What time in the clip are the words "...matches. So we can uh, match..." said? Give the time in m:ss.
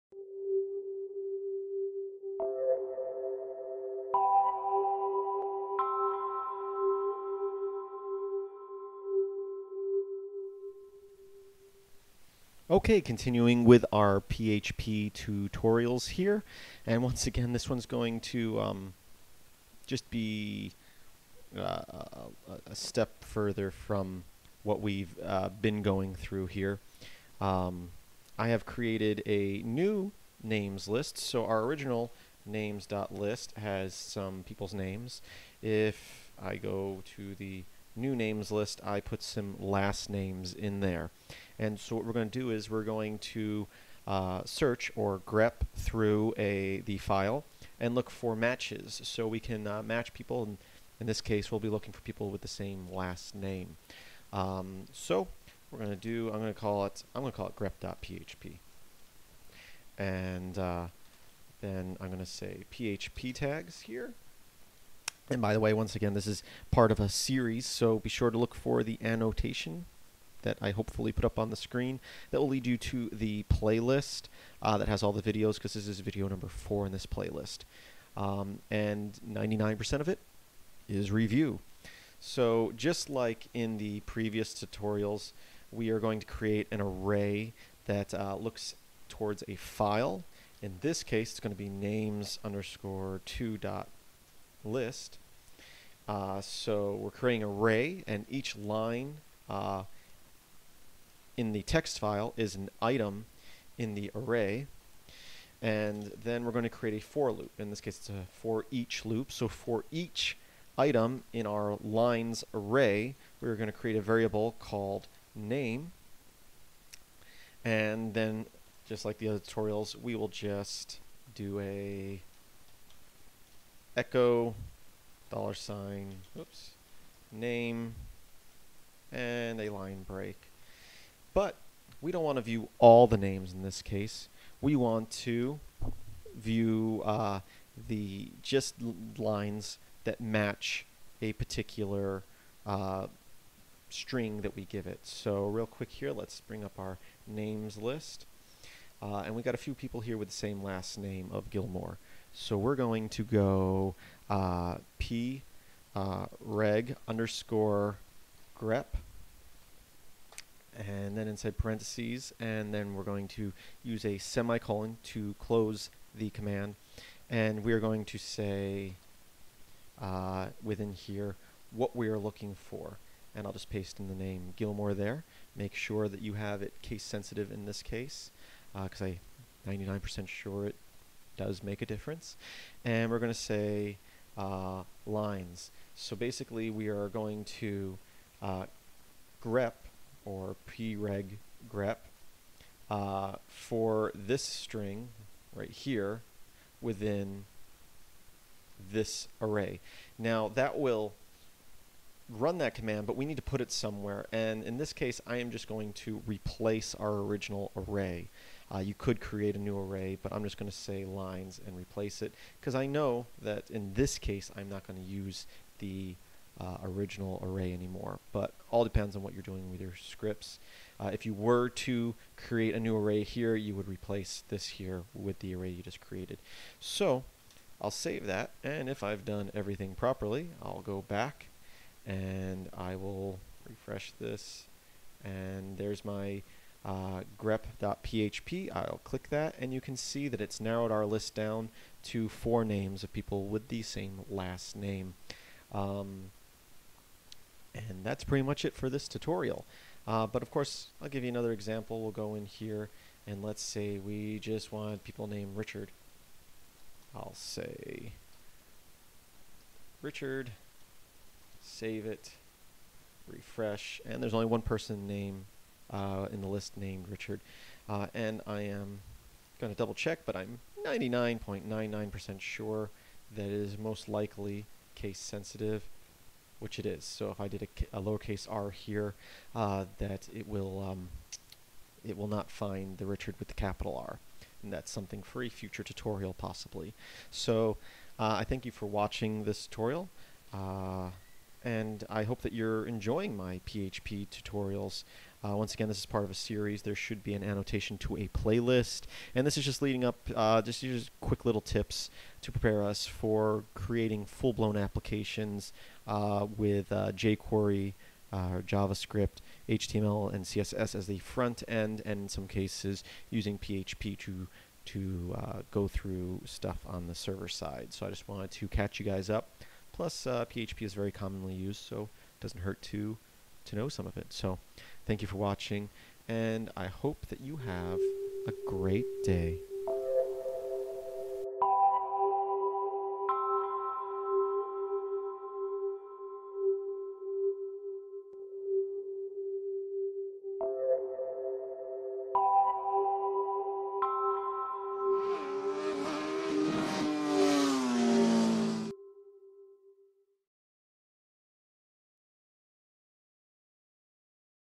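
0:48.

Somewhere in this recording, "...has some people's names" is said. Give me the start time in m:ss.
0:33.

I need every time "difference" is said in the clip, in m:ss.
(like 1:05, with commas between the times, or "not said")
3:01.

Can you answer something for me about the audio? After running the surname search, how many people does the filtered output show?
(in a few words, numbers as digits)
4.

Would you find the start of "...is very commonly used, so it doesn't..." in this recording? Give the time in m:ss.
5:20.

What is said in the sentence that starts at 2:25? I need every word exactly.
So real quick here, let's bring up our names list.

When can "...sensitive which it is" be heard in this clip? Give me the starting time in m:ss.
4:35.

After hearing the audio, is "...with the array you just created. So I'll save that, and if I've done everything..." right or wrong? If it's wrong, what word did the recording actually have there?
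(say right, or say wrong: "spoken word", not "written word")
right.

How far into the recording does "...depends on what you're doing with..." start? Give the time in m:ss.
3:38.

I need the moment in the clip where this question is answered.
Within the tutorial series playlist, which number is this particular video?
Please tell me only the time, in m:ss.
1:15.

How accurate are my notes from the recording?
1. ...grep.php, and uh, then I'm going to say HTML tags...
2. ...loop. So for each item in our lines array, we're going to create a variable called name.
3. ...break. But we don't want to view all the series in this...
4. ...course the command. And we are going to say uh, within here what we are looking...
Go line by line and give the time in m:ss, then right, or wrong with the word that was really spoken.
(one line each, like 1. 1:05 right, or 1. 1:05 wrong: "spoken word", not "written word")
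1. 0:57 wrong: "PHP", not "HTML"
2. 1:49 right
3. 2:10 wrong: "names", not "series"
4. 2:45 wrong: "close", not "course".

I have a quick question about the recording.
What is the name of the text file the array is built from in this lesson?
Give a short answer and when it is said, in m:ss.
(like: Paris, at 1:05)
names_2.list, at 1:31.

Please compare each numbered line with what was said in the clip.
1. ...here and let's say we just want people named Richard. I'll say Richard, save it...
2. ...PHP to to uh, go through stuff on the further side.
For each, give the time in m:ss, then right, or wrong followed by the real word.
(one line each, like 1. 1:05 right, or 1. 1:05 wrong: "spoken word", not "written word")
1. 4:12 right
2. 5:13 wrong: "server", not "further".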